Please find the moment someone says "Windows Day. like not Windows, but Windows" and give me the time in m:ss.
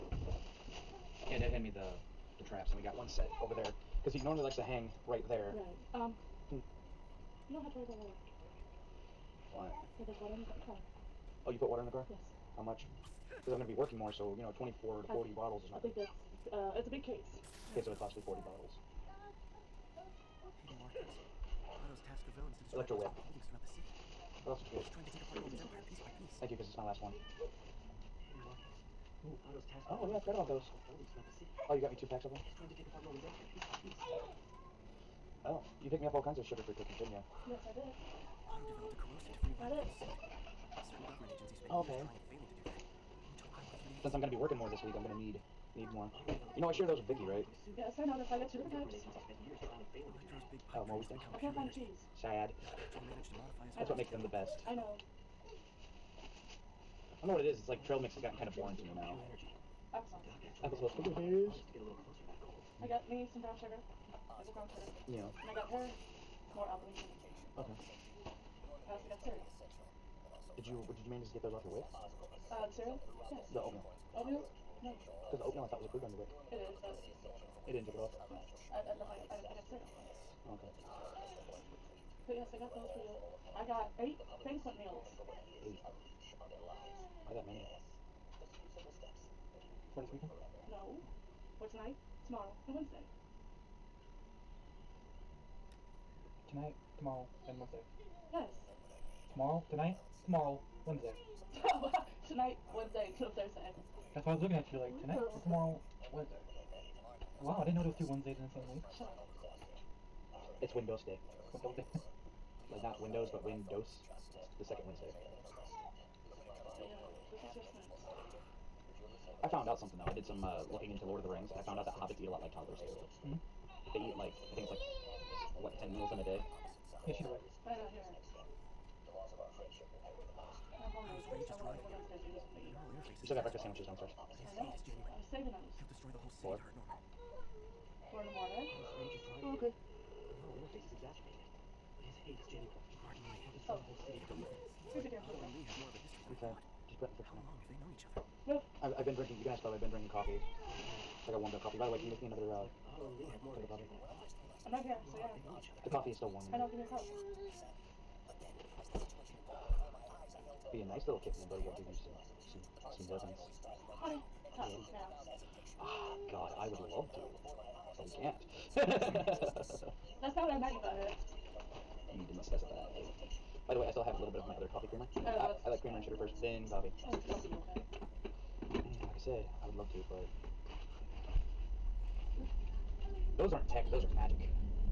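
1:51.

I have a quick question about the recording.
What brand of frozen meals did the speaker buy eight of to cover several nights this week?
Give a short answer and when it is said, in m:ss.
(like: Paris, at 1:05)
Banquet, at 1:24.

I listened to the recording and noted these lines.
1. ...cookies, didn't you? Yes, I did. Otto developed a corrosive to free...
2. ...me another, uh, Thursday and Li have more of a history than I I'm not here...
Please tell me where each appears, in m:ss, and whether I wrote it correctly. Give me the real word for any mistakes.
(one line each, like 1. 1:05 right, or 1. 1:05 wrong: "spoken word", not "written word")
1. 0:36 right
2. 2:32 wrong: "Otto", not "Thursday".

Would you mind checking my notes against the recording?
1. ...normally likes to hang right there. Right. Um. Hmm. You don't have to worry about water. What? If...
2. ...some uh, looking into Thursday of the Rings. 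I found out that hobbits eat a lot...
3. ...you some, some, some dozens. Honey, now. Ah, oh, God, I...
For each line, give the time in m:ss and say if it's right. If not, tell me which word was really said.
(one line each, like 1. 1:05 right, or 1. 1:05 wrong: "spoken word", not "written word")
1. 0:04 right
2. 2:00 wrong: "Lord", not "Thursday"
3. 2:41 right.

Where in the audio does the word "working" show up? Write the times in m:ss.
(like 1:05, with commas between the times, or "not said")
0:13, 0:44.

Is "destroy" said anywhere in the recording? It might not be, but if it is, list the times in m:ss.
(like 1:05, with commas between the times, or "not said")
2:16, 2:23.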